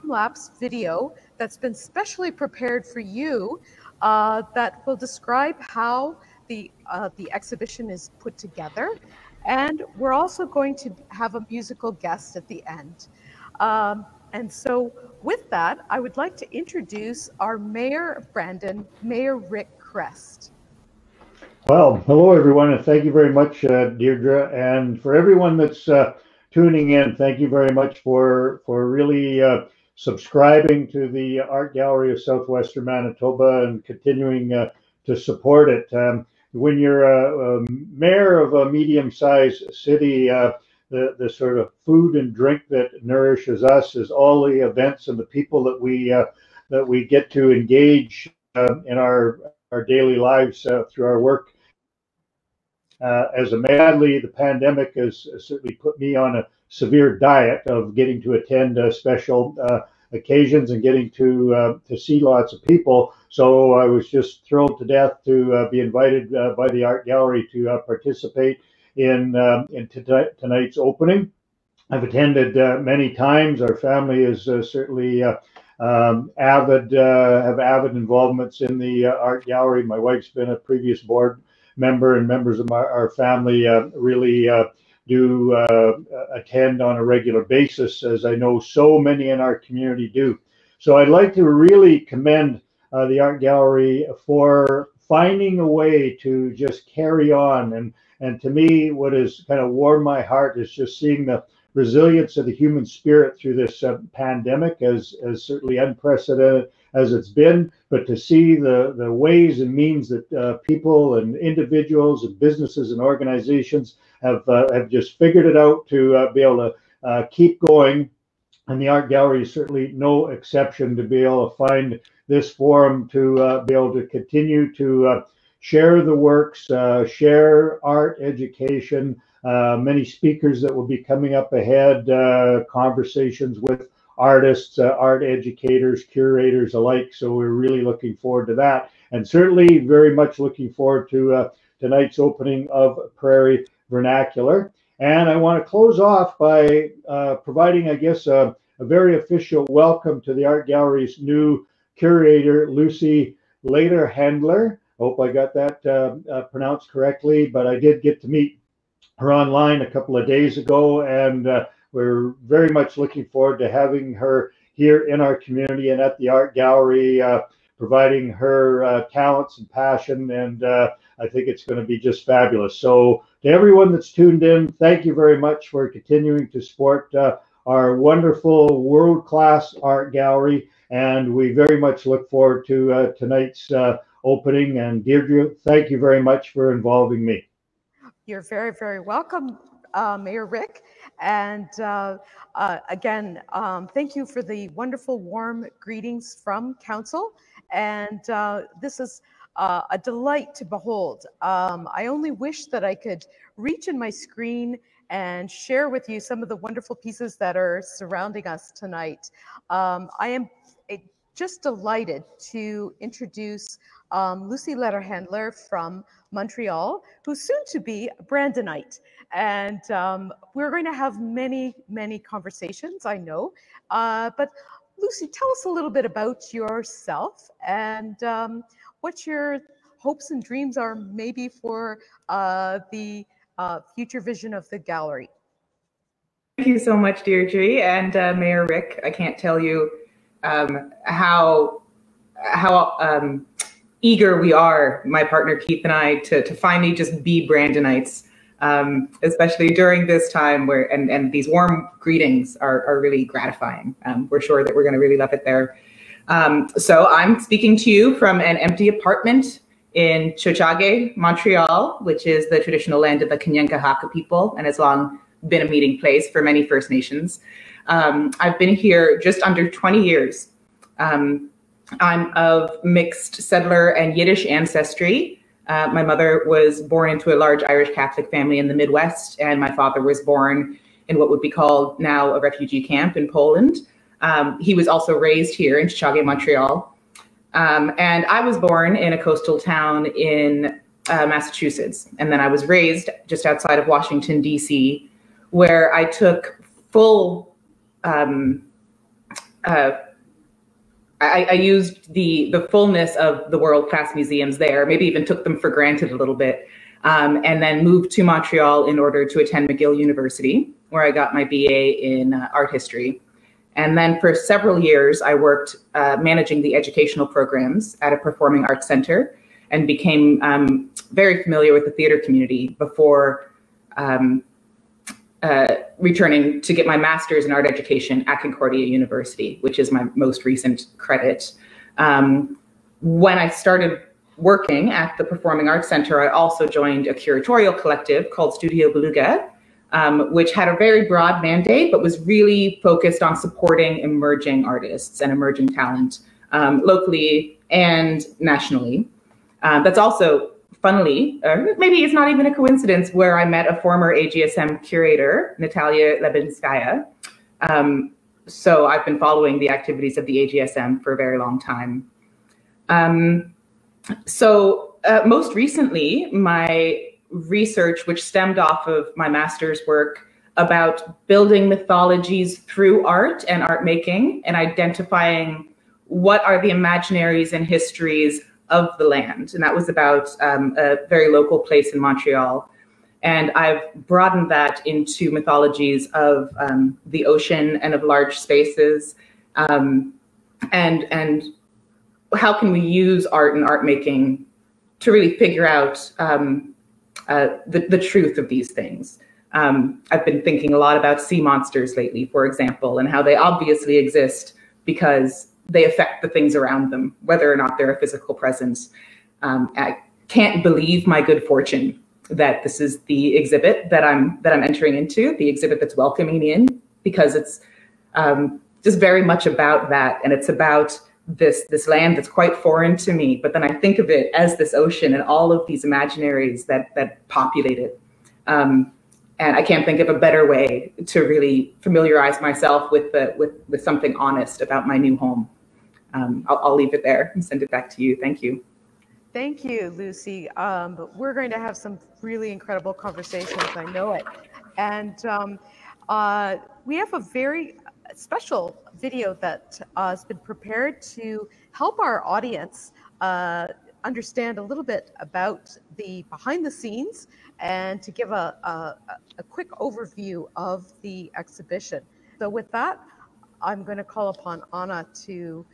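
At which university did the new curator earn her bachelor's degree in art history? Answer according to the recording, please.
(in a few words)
McGill University.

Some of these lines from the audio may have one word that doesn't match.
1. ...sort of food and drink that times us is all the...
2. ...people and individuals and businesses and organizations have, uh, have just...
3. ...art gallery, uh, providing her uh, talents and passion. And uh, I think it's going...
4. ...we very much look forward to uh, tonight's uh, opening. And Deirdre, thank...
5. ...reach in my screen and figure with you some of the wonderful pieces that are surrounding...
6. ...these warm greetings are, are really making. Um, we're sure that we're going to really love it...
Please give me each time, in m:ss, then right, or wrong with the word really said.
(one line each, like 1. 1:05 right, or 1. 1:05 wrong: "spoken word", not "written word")
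1. 0:41 wrong: "nourishes", not "times"
2. 1:50 right
3. 2:46 right
4. 3:01 right
5. 3:23 wrong: "share", not "figure"
6. 4:11 wrong: "gratifying", not "making".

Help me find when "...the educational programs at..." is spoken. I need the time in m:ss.
5:16.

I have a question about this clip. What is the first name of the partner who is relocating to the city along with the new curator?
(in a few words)
Keith.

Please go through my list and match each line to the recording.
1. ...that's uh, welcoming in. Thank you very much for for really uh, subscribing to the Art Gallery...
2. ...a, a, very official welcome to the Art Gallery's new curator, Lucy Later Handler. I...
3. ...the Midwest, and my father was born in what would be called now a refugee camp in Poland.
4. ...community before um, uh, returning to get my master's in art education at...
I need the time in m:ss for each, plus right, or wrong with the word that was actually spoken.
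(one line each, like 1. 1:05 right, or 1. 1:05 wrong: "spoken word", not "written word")
1. 0:25 wrong: "tuning", not "welcoming"
2. 2:28 right
3. 4:38 right
4. 5:22 right.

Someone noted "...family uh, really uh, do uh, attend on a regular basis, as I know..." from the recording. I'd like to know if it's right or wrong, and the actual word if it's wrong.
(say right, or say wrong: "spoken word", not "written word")
right.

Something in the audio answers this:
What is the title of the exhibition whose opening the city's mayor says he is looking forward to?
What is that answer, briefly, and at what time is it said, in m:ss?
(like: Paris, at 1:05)
Prairie Vernacular, at 2:23.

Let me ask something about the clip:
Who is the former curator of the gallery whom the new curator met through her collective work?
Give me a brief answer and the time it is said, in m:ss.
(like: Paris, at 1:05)
Natalia Lebedinskaia, at 5:55.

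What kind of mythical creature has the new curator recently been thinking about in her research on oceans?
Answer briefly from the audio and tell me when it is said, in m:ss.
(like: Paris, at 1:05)
Sea monsters, at 6:41.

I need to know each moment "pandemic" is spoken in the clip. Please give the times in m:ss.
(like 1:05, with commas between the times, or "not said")
0:54, 1:44.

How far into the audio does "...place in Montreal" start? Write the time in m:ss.
6:21.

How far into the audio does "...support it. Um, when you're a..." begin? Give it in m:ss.
0:35.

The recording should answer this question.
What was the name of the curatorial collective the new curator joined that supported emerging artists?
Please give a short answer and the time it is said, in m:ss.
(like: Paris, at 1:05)
Studio Beluga, at 5:38.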